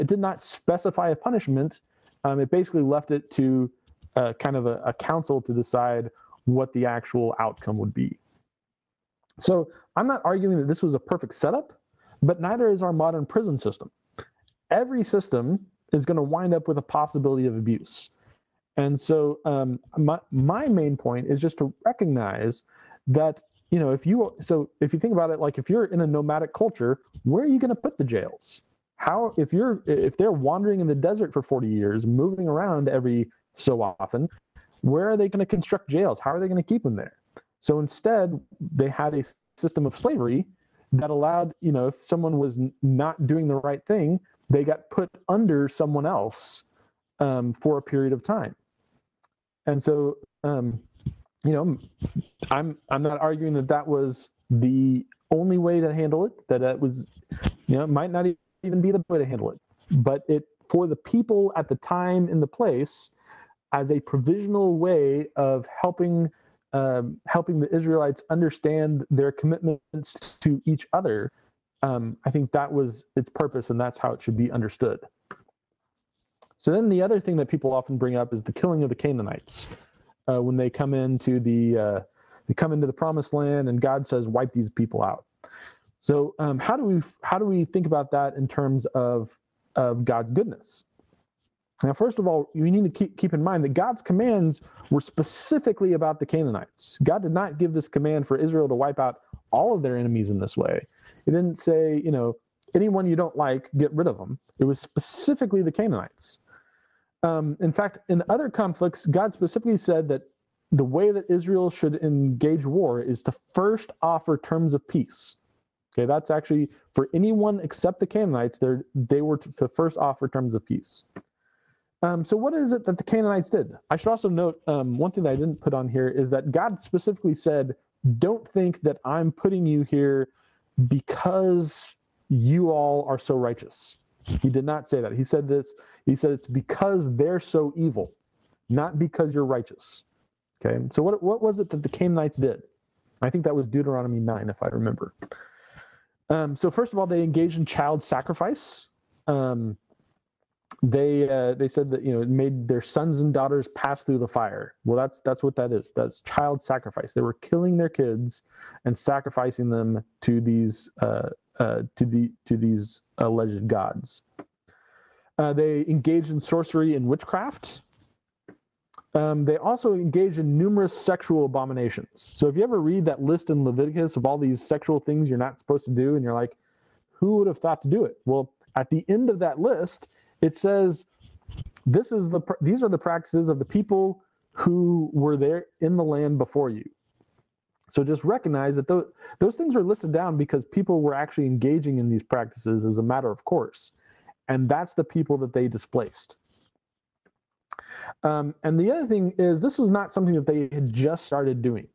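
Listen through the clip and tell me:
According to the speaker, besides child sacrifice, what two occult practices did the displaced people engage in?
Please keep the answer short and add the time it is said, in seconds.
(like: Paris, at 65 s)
Sorcery and witchcraft, at 166 s.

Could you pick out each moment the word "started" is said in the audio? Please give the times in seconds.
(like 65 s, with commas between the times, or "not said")
201 s.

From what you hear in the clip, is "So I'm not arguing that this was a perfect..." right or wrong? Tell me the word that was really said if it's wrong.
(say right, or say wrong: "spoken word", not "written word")
right.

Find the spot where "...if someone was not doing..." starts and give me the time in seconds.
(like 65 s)
41 s.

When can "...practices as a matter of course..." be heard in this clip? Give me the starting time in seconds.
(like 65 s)
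192 s.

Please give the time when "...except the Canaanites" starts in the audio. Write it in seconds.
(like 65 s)
117 s.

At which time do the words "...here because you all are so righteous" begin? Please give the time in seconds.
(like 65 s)
129 s.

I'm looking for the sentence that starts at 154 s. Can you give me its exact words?
Well, that's that's what that is.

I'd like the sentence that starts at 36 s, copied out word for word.
How are they going to keep them there?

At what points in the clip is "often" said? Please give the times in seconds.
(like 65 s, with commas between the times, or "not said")
33 s, 77 s.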